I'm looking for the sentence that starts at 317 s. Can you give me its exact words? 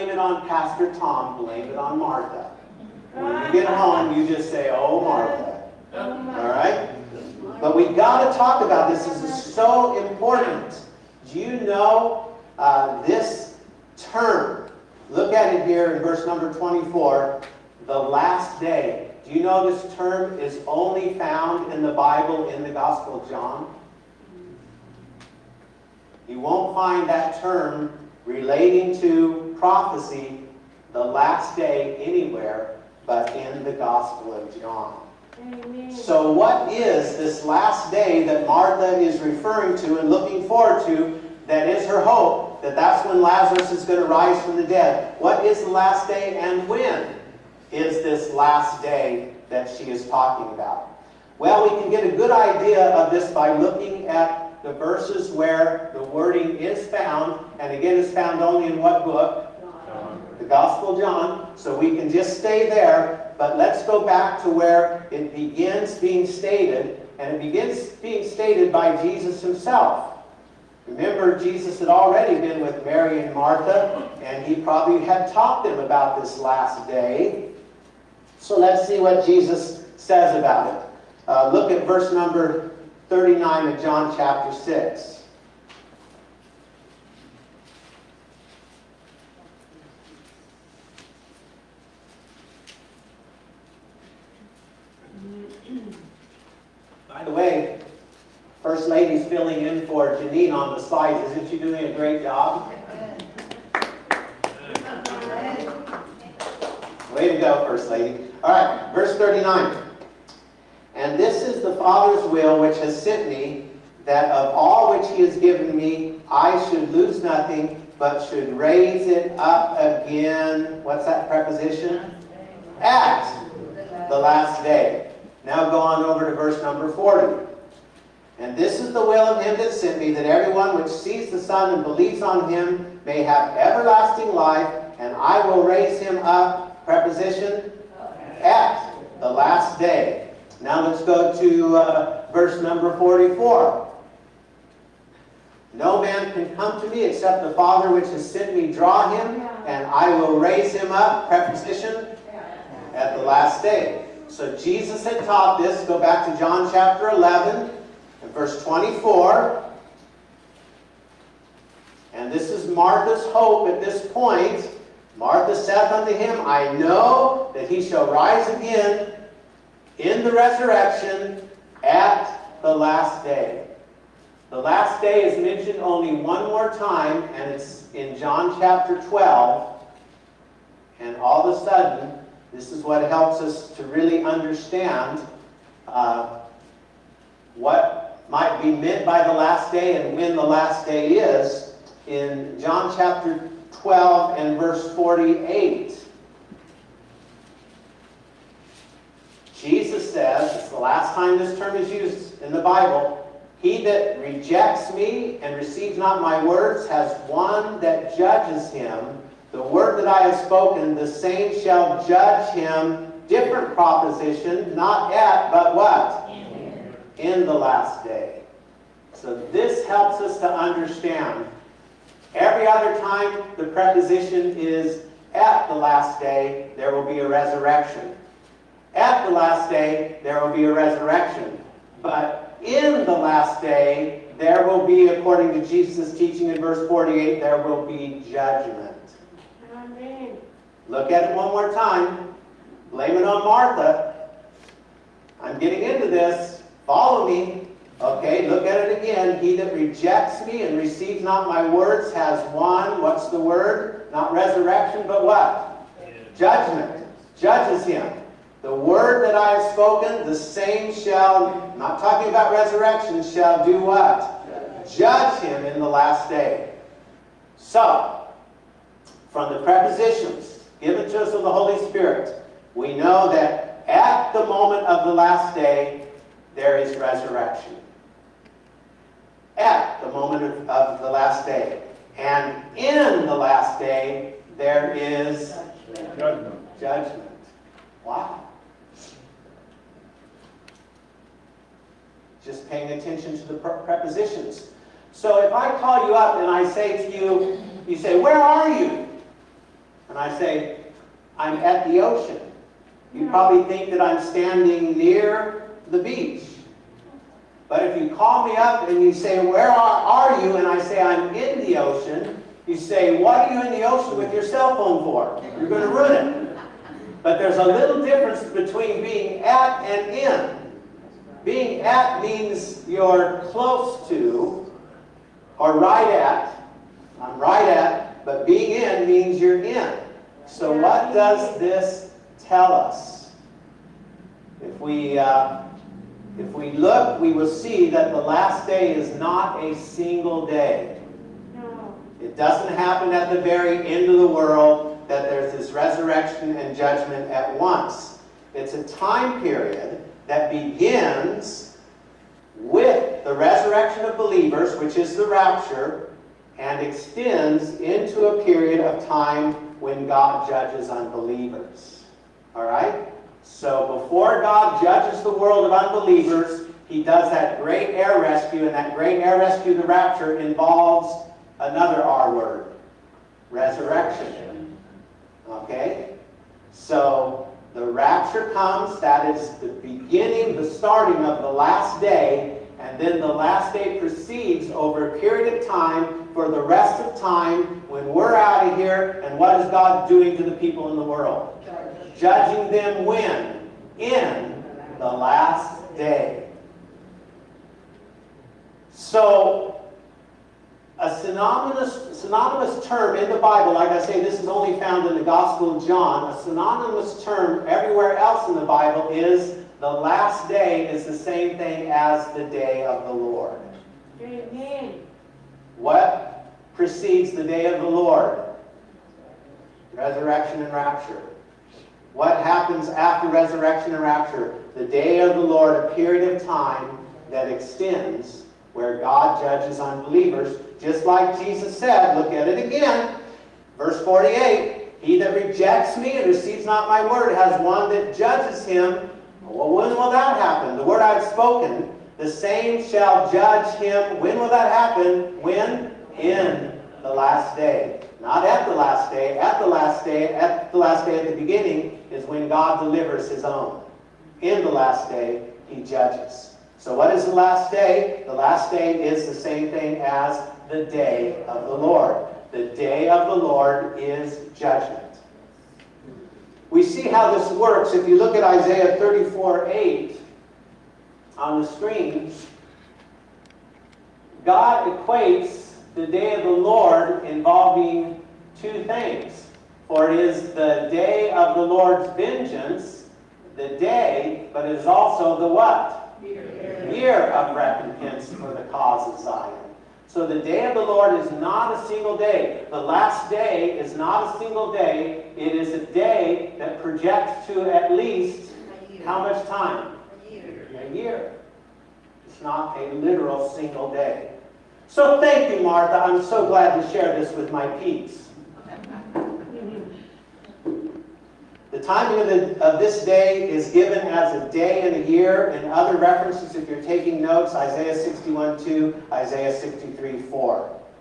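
But there's a little difference between being at and in.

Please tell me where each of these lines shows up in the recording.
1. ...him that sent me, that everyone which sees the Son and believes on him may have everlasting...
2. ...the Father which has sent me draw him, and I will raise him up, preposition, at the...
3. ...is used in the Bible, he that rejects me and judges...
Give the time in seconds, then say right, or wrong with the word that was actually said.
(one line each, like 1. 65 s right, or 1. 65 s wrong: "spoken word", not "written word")
1. 129 s right
2. 147 s right
3. 201 s wrong: "receives", not "judges".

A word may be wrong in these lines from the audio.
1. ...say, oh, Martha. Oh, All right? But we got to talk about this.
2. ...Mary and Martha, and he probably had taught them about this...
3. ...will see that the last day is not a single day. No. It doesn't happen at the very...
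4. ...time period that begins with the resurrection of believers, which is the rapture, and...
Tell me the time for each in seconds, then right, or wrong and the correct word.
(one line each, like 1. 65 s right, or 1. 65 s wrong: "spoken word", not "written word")
1. 4 s right
2. 72 s right
3. 337 s right
4. 348 s right.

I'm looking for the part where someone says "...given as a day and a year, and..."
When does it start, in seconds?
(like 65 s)
513 s.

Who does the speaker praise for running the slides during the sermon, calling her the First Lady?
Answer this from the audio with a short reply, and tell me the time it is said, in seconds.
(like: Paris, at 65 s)
Janine, at 100 s.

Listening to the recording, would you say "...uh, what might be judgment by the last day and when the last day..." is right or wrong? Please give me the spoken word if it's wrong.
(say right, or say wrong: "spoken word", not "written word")
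wrong: "meant", not "judgment".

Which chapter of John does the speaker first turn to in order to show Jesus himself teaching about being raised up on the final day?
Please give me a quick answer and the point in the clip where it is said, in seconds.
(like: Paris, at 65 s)
chapter 6, at 83 s.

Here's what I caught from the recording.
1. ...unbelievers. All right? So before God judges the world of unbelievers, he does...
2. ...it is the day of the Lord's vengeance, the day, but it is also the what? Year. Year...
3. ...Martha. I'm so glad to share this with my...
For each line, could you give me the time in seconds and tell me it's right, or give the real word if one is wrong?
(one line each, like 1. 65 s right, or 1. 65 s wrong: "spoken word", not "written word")
1. 360 s right
2. 480 s right
3. 505 s right.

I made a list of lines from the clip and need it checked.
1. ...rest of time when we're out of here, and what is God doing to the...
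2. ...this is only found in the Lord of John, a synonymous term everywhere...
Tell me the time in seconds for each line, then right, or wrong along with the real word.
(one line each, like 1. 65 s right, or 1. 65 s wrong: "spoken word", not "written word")
1. 386 s right
2. 404 s wrong: "Gospel", not "Lord".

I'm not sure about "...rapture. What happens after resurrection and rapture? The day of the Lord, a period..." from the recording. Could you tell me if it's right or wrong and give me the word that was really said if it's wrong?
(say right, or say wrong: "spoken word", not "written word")
right.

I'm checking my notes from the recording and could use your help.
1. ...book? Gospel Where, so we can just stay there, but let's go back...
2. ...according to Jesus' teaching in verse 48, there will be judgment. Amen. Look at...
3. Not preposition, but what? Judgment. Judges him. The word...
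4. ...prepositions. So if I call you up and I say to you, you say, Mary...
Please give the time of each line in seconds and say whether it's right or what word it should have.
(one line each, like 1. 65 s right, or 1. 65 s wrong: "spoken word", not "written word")
1. 59 s wrong: "John", not "Where"
2. 235 s right
3. 254 s wrong: "resurrection", not "preposition"
4. 293 s wrong: "Where", not "Mary".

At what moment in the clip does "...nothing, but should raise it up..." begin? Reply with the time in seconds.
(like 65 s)
117 s.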